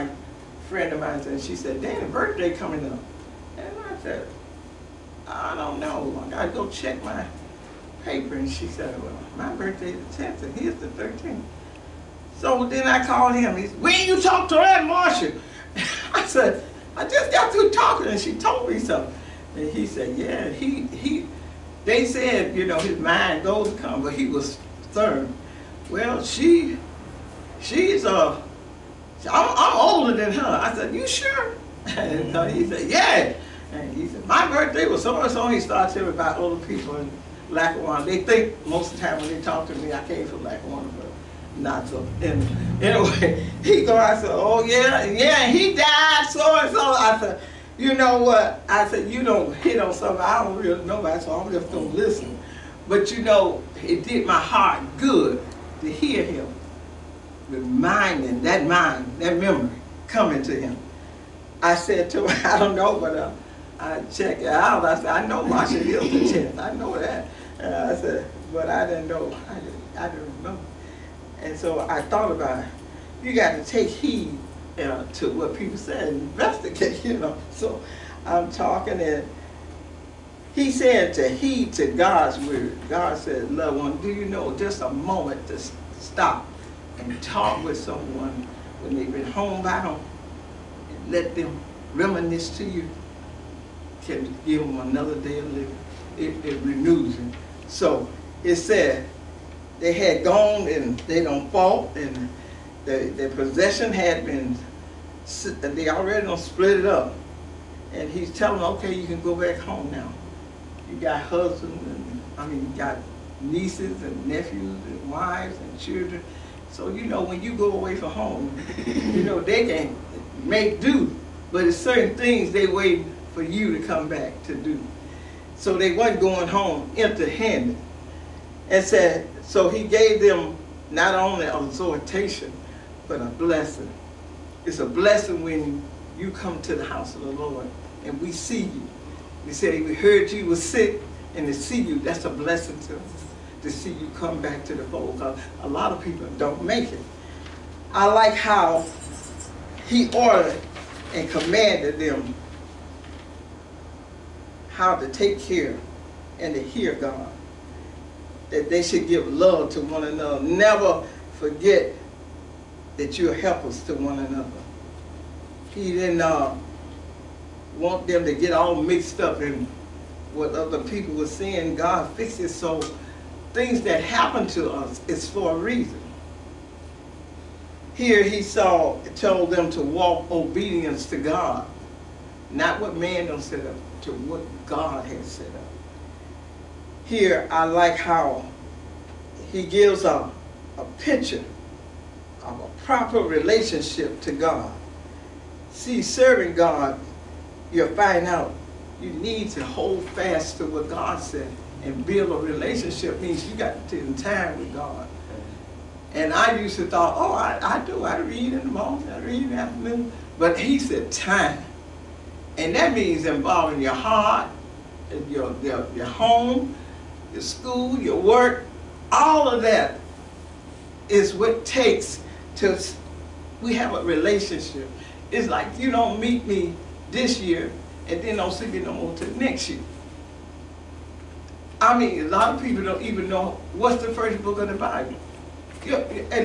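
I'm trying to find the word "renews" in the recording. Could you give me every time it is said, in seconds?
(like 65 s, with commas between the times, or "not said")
96 s.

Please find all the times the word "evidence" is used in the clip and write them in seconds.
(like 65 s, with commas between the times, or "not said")
not said.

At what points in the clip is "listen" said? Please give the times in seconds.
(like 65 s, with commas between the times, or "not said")
51 s.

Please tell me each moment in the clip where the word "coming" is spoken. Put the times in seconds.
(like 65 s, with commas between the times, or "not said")
2 s, 60 s.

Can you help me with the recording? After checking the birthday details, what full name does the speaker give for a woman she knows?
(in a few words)
Marsha Hilton.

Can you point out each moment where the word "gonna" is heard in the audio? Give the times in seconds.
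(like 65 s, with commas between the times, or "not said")
51 s.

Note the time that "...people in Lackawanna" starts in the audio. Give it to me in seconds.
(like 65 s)
36 s.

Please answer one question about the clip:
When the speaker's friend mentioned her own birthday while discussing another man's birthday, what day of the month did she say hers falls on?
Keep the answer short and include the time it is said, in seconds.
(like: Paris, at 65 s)
10th, at 10 s.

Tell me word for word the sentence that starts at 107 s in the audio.
And he's telling them, okay, you can go back home now.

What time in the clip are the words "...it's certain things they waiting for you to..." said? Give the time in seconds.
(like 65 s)
121 s.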